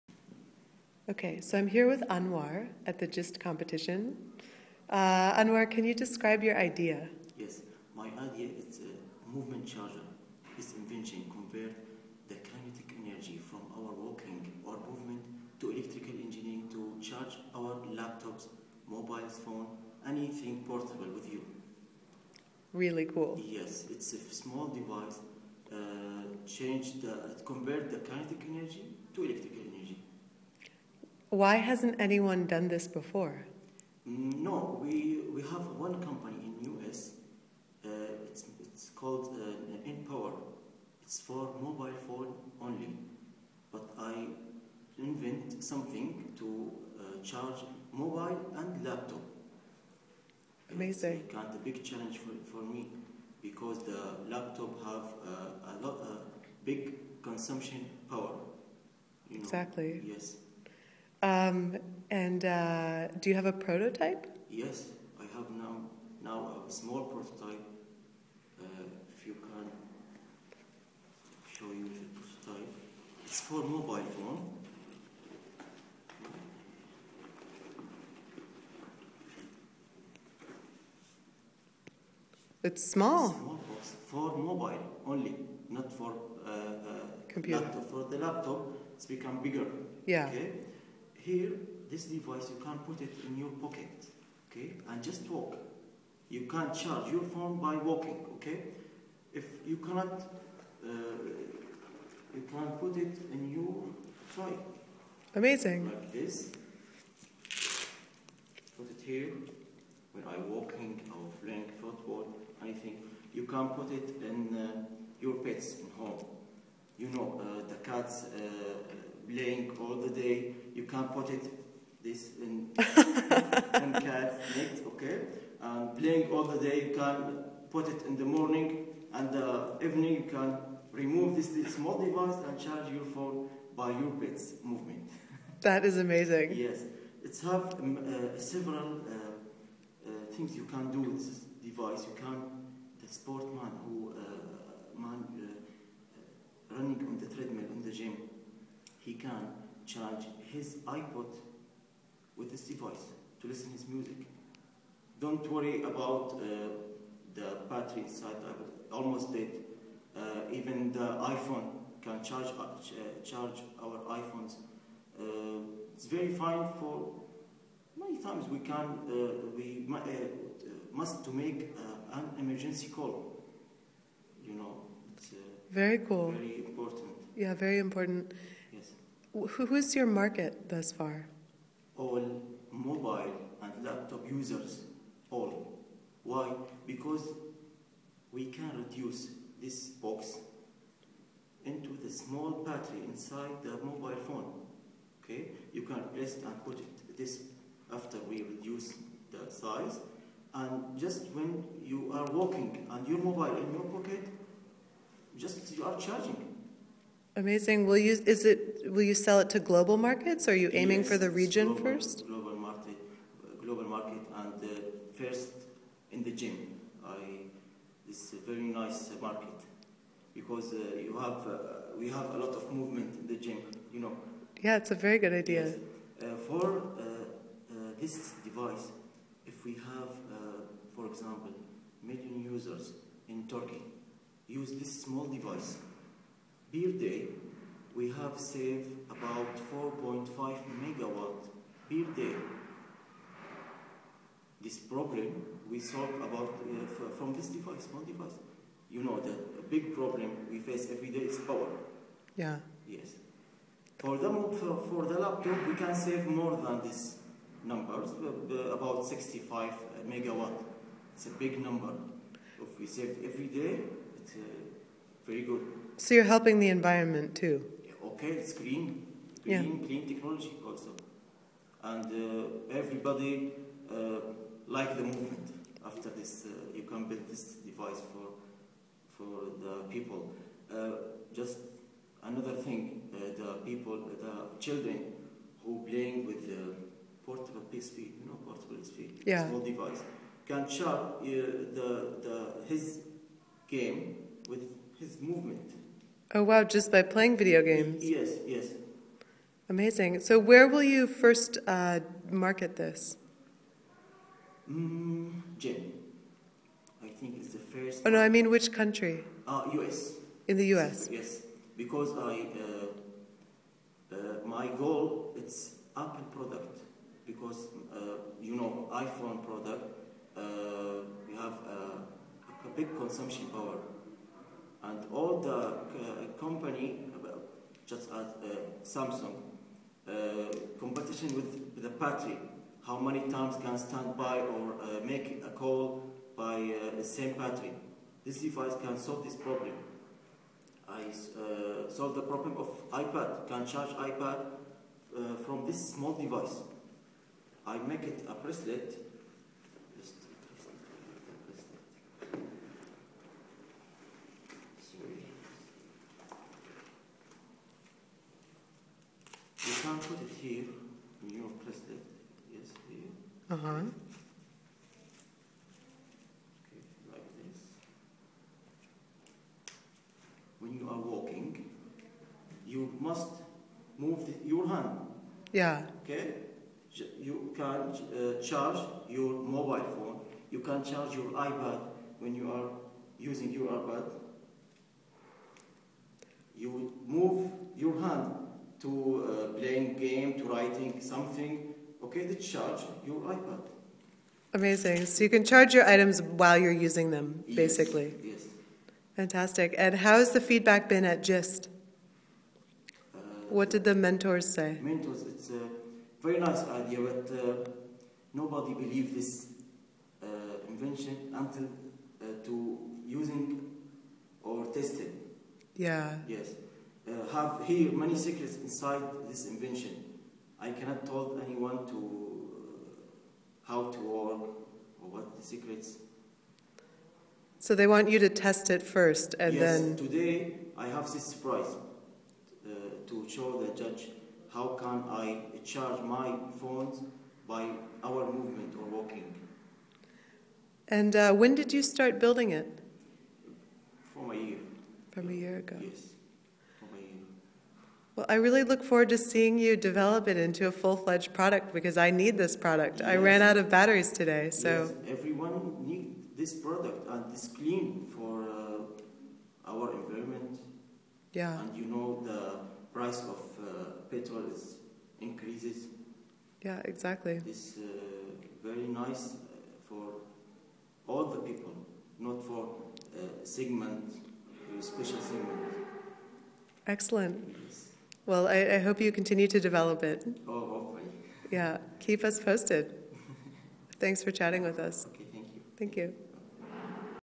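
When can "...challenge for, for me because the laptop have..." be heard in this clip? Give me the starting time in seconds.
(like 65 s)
51 s.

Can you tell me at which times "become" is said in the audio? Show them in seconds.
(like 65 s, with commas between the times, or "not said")
89 s.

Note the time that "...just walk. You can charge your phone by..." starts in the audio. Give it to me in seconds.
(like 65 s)
95 s.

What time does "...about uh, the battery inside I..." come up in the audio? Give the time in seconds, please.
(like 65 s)
155 s.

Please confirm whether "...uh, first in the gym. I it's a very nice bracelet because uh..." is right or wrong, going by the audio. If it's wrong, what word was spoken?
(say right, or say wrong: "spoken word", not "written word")
wrong: "market", not "bracelet".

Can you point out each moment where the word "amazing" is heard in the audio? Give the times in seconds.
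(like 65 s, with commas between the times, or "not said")
50 s, 105 s, 135 s, 207 s, 299 s, 394 s.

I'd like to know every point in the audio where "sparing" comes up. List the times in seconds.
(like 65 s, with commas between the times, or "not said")
not said.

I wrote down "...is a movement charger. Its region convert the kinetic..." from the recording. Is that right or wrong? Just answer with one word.
wrong.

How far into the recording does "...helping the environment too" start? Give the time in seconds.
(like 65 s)
266 s.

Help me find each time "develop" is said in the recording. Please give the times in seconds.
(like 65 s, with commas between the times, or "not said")
449 s, 479 s.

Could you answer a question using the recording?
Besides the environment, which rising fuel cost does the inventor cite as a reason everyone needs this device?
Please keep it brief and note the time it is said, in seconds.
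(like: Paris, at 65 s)
Petrol, at 464 s.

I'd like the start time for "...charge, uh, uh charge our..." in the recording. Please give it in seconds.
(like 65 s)
162 s.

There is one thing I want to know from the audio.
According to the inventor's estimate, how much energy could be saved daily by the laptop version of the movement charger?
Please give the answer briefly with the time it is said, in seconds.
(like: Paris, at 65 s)
65 megawatts, at 259 s.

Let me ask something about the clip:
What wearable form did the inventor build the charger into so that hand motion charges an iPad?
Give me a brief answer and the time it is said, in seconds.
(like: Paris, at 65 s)
Bracelet, at 348 s.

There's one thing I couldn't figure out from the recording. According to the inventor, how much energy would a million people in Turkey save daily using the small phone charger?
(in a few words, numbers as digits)
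4.5 megawatts.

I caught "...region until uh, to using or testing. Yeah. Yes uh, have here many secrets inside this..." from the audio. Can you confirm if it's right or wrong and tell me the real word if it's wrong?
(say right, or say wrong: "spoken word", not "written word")
wrong: "invention", not "region".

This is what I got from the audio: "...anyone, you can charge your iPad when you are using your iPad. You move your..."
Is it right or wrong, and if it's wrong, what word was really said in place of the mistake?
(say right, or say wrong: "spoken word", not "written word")
wrong: "phone", not "anyone".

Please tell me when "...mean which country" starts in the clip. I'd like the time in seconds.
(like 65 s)
308 s.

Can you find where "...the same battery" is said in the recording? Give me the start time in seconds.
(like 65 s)
336 s.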